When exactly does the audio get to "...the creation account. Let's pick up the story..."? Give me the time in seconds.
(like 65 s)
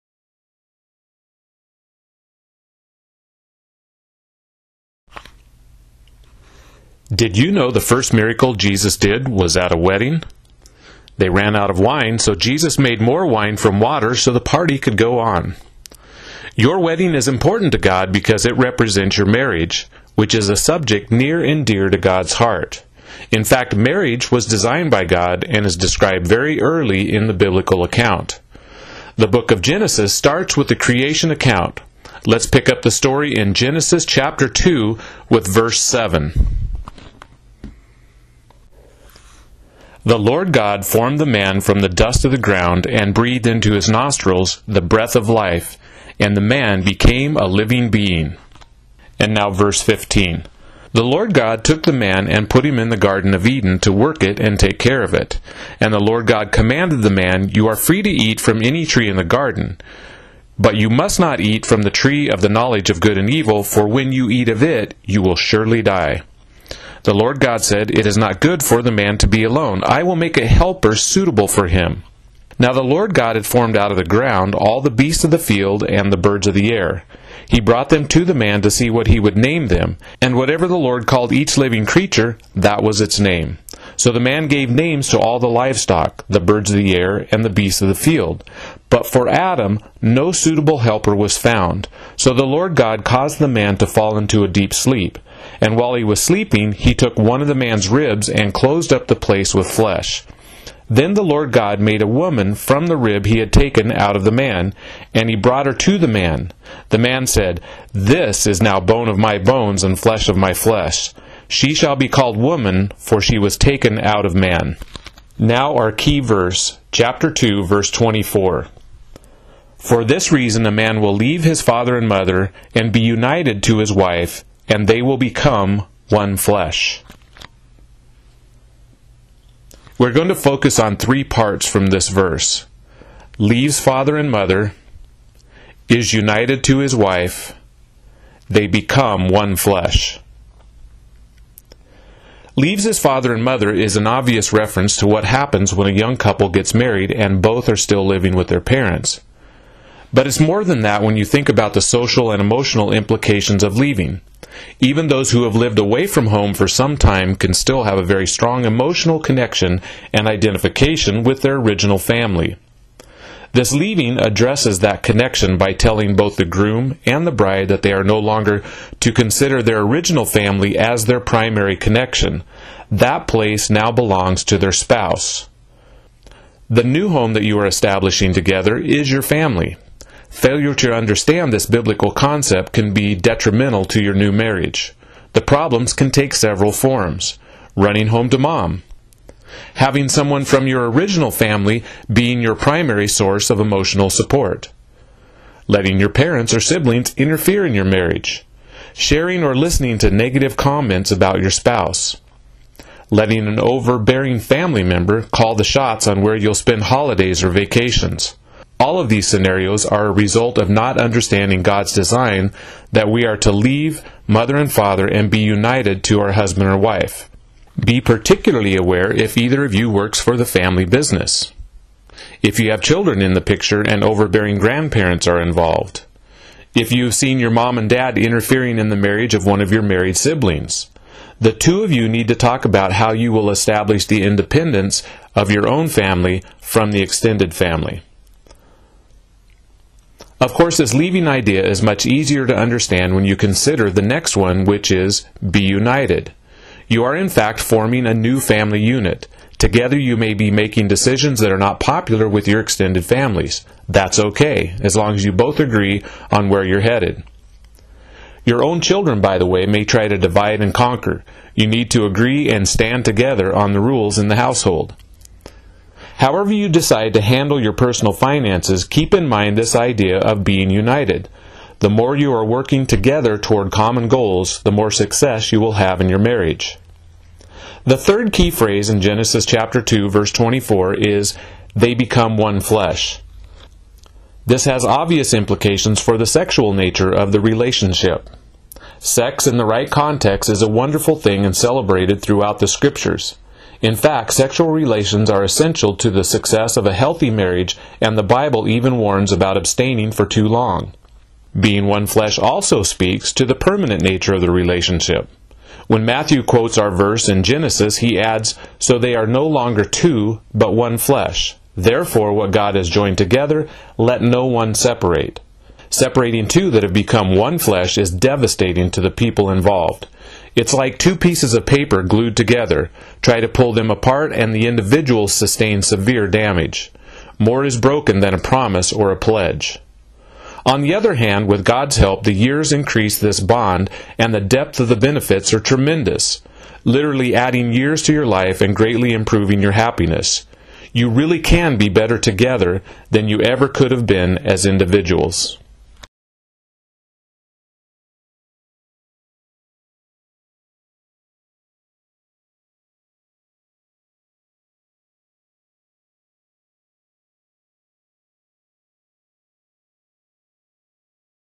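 30 s.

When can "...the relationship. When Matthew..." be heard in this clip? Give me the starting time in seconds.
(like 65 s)
304 s.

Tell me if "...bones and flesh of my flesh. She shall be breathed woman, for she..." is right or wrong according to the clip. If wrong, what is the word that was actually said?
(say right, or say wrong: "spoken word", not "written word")
wrong: "called", not "breathed".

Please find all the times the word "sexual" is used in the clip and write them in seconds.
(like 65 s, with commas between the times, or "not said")
286 s, 294 s.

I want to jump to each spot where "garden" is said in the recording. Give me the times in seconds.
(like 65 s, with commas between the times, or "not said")
52 s, 59 s.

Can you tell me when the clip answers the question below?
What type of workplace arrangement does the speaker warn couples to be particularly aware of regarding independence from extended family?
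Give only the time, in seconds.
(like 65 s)
220 s.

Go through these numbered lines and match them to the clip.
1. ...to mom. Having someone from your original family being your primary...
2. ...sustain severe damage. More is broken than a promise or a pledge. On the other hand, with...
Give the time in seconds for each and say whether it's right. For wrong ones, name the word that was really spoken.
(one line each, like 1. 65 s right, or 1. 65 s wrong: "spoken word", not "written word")
1. 188 s right
2. 325 s right.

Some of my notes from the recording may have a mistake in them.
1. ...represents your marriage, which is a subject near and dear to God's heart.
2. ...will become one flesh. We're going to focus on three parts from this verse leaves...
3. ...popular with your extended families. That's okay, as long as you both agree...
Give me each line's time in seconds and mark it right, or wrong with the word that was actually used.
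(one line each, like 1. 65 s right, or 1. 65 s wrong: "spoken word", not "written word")
1. 18 s right
2. 125 s right
3. 251 s right.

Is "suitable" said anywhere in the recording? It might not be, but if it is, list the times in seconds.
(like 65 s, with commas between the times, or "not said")
70 s, 90 s.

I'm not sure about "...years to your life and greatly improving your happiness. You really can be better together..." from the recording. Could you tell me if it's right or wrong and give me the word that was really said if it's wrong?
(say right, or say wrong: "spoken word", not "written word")
right.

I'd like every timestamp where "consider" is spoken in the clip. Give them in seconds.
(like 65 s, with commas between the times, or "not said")
169 s, 243 s.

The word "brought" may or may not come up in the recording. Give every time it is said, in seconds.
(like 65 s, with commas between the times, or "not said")
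77 s, 105 s.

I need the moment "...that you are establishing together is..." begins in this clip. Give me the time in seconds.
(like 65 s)
177 s.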